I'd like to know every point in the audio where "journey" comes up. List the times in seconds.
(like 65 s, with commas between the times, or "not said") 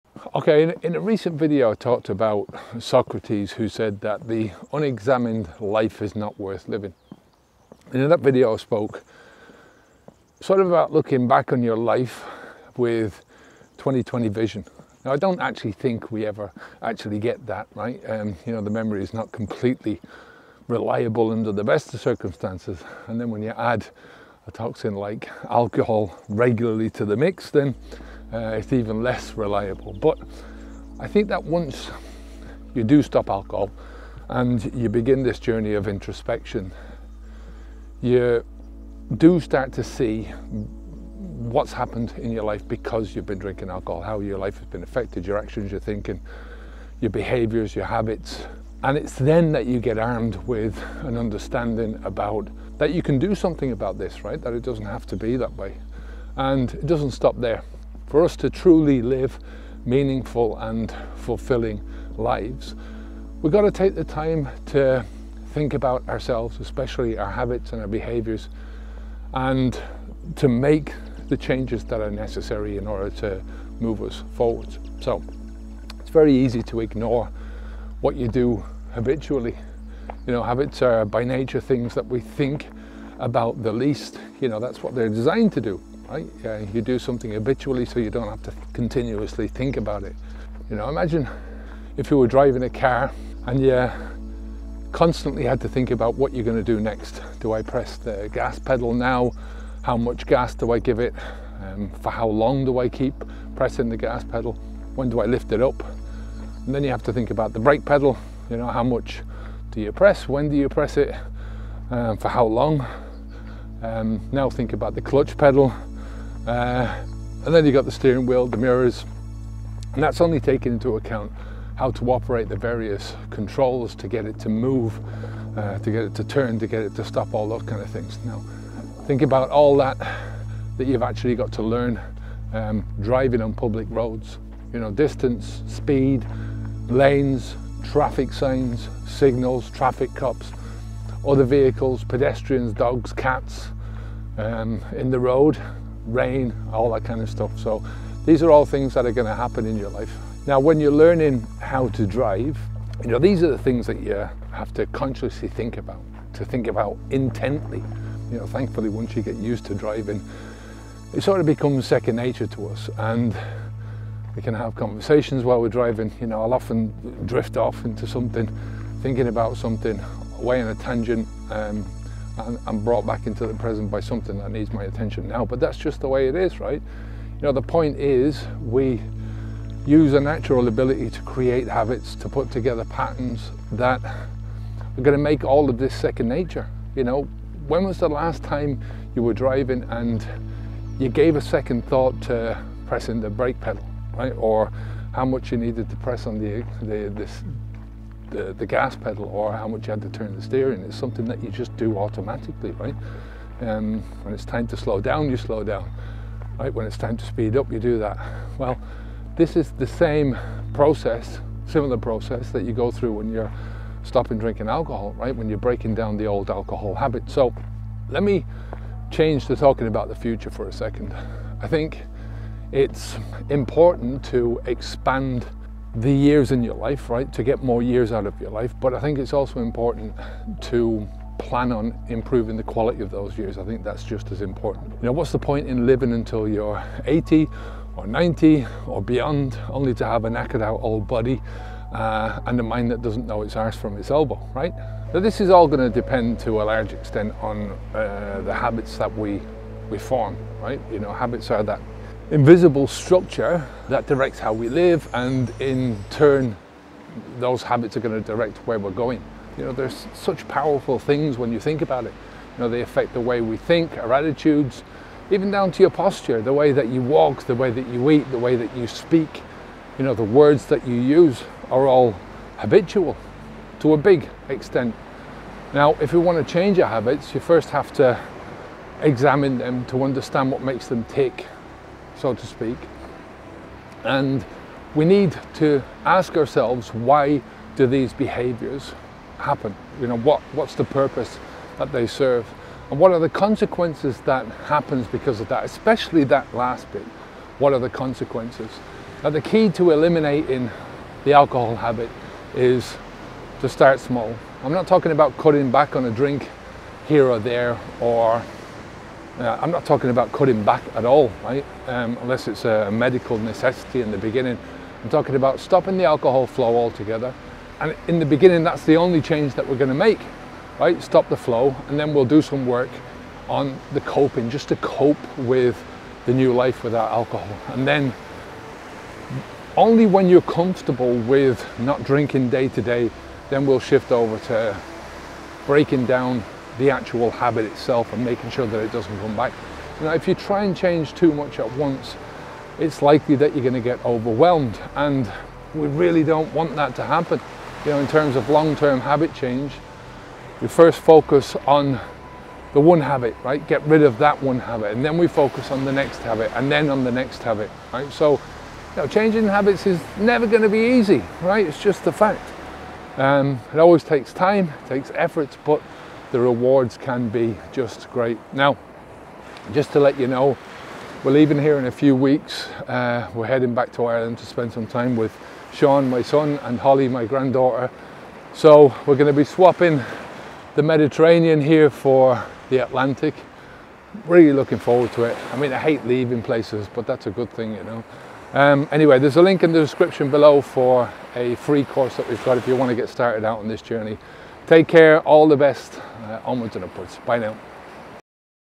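35 s, 393 s.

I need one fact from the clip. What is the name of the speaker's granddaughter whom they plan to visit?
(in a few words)
Holly.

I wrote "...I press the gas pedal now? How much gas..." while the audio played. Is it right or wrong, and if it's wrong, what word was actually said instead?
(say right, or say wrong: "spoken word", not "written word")
right.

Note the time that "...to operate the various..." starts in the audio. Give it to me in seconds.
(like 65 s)
121 s.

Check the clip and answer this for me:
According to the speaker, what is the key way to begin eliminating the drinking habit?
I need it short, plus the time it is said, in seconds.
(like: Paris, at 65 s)
start small, at 303 s.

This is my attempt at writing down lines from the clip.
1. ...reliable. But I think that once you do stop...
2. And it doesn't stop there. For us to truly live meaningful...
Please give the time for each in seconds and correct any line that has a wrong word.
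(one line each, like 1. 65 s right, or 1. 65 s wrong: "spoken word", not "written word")
1. 29 s right
2. 56 s right.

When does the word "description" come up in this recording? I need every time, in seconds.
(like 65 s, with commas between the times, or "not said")
389 s.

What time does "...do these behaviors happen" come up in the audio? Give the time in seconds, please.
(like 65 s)
287 s.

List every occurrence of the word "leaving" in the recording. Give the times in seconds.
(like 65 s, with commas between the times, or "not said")
371 s, 386 s.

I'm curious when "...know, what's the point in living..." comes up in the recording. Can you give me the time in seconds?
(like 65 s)
235 s.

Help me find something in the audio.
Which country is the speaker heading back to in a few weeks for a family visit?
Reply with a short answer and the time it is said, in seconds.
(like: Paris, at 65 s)
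Ireland, at 374 s.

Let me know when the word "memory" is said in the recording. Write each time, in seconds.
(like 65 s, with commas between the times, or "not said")
18 s.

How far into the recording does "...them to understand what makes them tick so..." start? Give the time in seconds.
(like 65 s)
279 s.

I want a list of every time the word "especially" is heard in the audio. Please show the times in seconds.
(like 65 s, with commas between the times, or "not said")
66 s, 295 s.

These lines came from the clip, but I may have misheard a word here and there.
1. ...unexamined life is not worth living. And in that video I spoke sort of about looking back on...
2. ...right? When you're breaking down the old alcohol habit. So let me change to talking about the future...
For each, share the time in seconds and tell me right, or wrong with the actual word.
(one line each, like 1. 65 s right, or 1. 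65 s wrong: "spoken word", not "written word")
1. 4 s right
2. 215 s right.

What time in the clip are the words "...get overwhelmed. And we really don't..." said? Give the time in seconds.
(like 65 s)
343 s.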